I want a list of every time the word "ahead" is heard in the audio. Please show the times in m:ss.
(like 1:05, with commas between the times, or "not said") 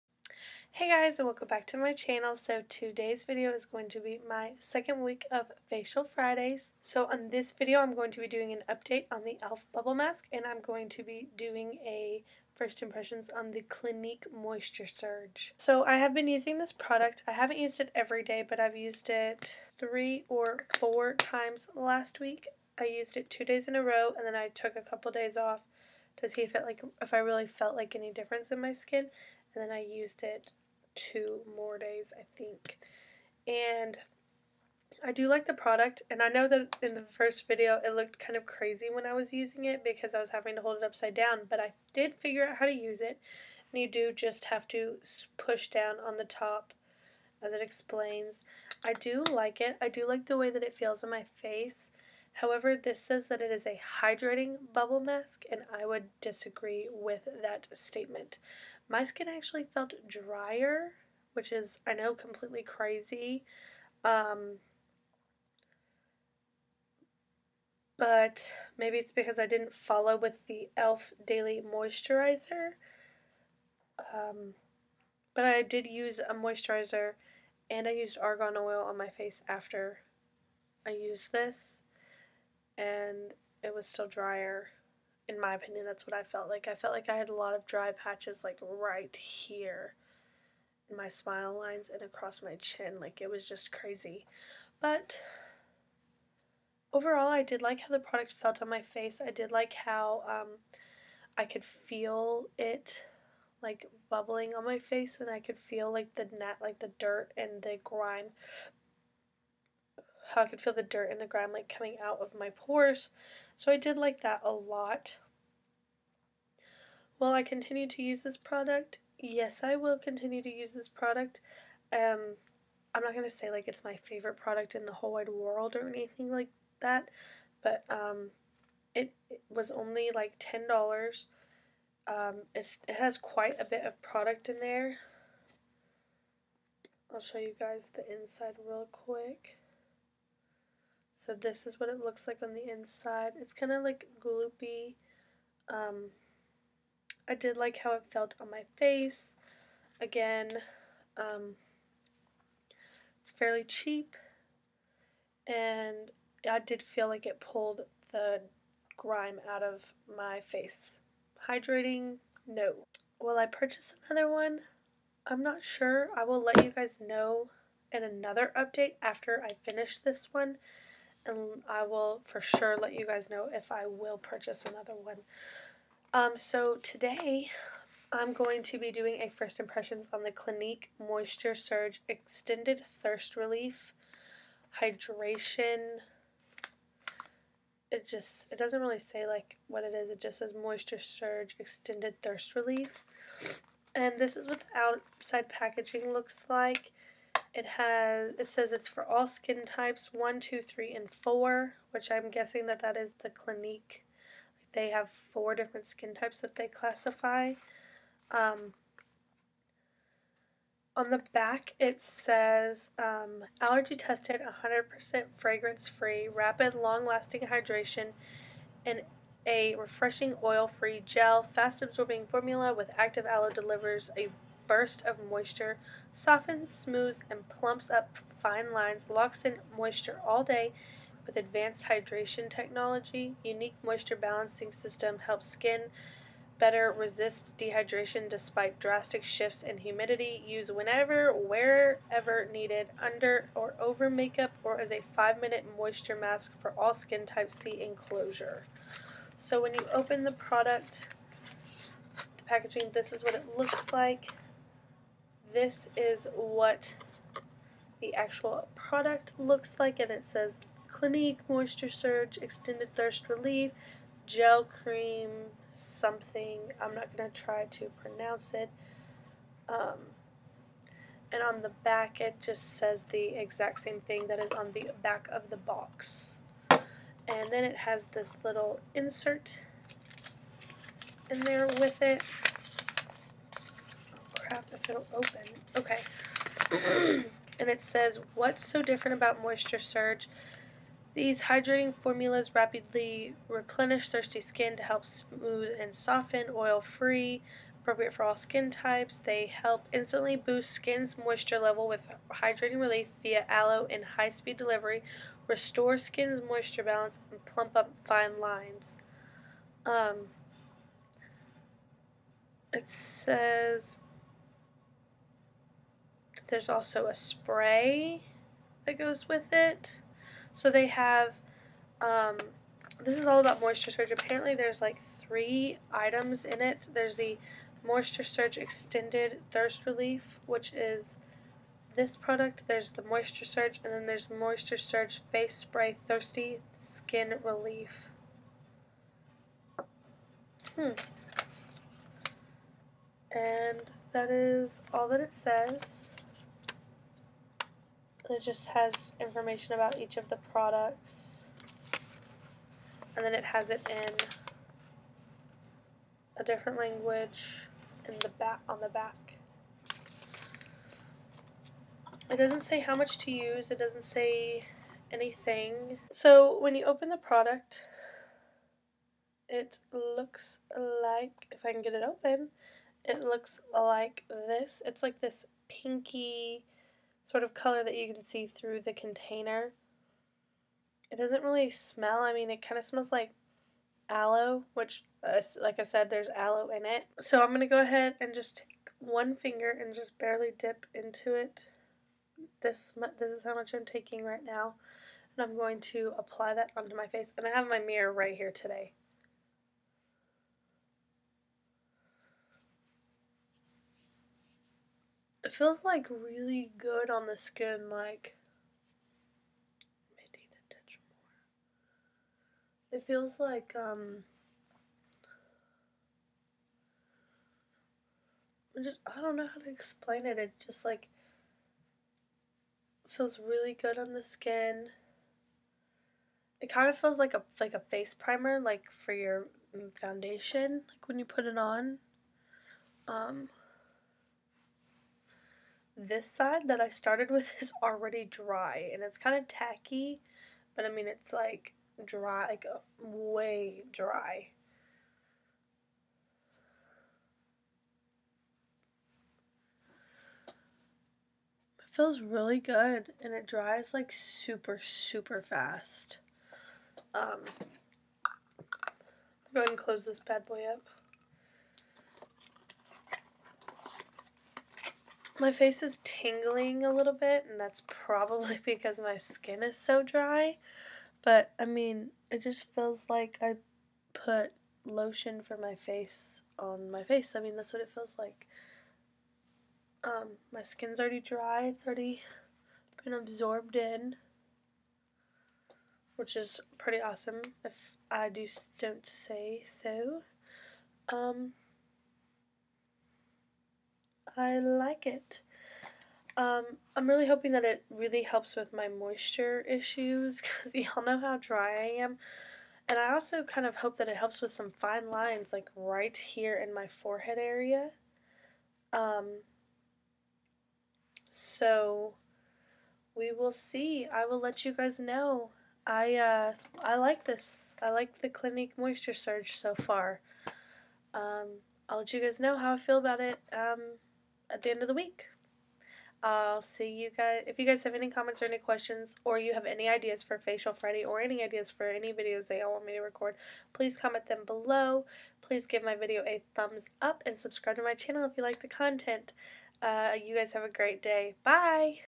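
6:27, 7:39.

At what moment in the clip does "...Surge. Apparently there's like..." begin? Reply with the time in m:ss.
5:23.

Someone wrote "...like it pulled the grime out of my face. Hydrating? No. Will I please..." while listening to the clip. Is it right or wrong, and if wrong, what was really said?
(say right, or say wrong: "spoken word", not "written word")
wrong: "purchase", not "please".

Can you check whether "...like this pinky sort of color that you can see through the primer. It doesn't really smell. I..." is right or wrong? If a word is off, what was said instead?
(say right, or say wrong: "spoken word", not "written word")
wrong: "container", not "primer".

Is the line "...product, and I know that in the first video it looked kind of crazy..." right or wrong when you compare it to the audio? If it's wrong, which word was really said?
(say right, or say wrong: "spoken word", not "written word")
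right.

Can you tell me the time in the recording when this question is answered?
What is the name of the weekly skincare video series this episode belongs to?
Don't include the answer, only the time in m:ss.
0:05.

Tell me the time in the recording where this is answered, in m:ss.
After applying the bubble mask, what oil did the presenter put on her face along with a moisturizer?
1:18.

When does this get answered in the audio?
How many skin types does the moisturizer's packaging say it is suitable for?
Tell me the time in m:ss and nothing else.
3:21.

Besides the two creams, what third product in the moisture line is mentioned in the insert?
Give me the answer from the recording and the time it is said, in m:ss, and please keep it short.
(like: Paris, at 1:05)
Face Spray, at 5:35.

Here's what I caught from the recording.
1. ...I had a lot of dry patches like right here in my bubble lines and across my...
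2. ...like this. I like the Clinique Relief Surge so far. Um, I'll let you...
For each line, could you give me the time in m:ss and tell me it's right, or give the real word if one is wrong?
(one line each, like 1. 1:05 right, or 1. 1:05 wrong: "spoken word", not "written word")
1. 1:27 wrong: "smile", not "bubble"
2. 8:36 wrong: "Moisture", not "Relief".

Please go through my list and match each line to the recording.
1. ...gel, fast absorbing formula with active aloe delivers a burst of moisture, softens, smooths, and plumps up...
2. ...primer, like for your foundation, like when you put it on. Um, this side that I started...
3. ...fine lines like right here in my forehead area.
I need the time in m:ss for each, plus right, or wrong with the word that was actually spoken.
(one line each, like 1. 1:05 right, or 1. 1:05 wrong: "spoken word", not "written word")
1. 3:41 right
2. 7:08 right
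3. 8:24 right.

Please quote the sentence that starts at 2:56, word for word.
Um, so today I'm going to be doing a first impressions on the Clinique Moisture Surge Extended Thirst Relief Hydration.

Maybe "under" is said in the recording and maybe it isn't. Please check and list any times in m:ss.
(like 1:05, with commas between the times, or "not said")
4:03.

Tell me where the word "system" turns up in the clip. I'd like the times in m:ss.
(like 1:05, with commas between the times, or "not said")
3:54.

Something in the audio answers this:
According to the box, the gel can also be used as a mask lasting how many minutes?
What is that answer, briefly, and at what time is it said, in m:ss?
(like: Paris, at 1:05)
5 minutes, at 4:05.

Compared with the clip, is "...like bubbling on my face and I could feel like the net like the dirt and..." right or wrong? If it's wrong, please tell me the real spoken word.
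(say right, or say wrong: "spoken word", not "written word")
right.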